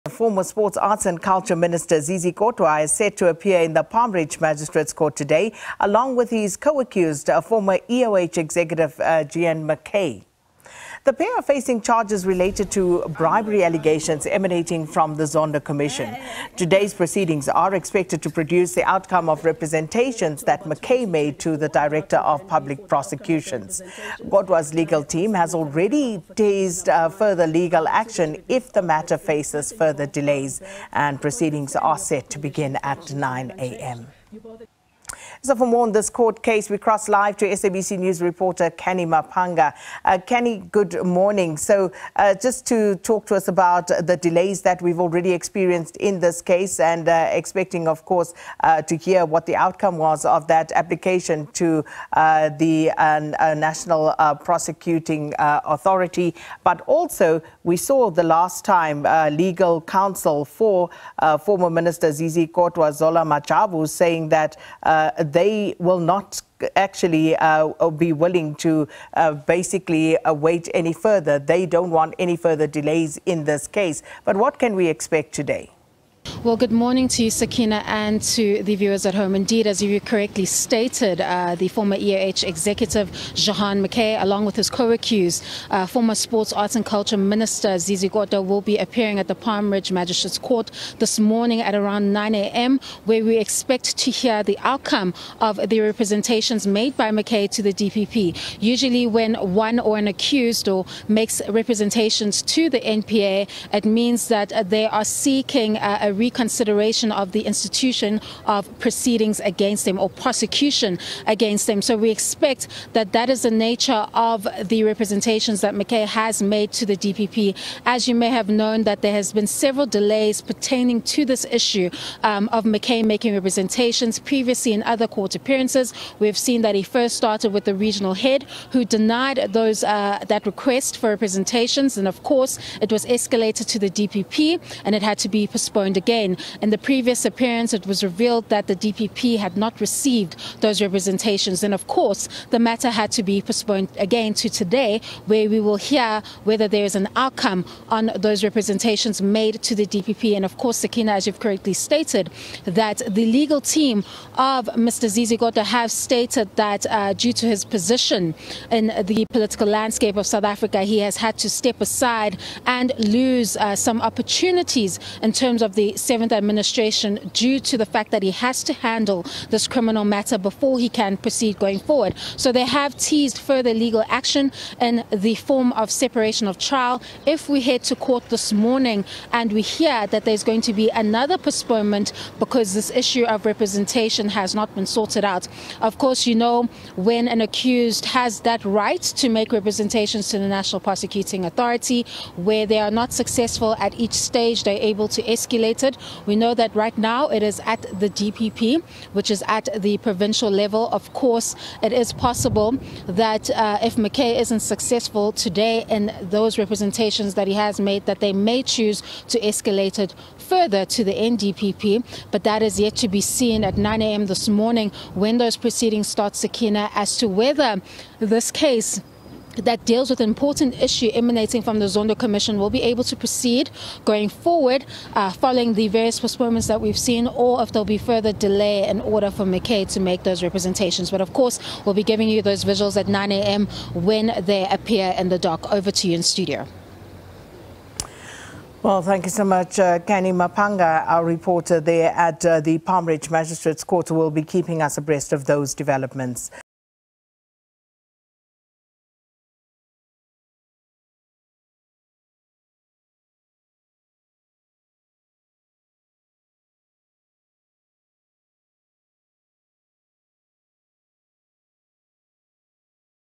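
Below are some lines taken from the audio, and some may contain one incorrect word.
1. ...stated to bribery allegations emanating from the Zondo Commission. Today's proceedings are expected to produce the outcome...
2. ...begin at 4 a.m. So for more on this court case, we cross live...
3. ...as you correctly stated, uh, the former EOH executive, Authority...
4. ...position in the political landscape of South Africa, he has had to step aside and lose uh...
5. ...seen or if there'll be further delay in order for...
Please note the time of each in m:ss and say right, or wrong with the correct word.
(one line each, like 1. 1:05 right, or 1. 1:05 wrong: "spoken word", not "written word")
1. 0:12 wrong: "related", not "stated"
2. 0:32 wrong: "9", not "4"
3. 1:19 wrong: "Jehan", not "Authority"
4. 2:37 right
5. 3:46 right.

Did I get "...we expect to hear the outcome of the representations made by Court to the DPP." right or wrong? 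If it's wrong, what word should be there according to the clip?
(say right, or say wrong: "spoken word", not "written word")
wrong: "Mackay", not "Court".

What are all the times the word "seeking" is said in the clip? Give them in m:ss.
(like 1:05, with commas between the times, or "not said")
1:45.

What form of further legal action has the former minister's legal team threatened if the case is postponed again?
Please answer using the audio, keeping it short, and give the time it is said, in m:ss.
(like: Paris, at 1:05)
separation of trial, at 2:55.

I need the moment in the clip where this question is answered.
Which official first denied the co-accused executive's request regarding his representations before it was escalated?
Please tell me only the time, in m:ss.
2:07.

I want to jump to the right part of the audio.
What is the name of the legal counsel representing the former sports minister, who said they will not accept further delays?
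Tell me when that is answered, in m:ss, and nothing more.
1:02.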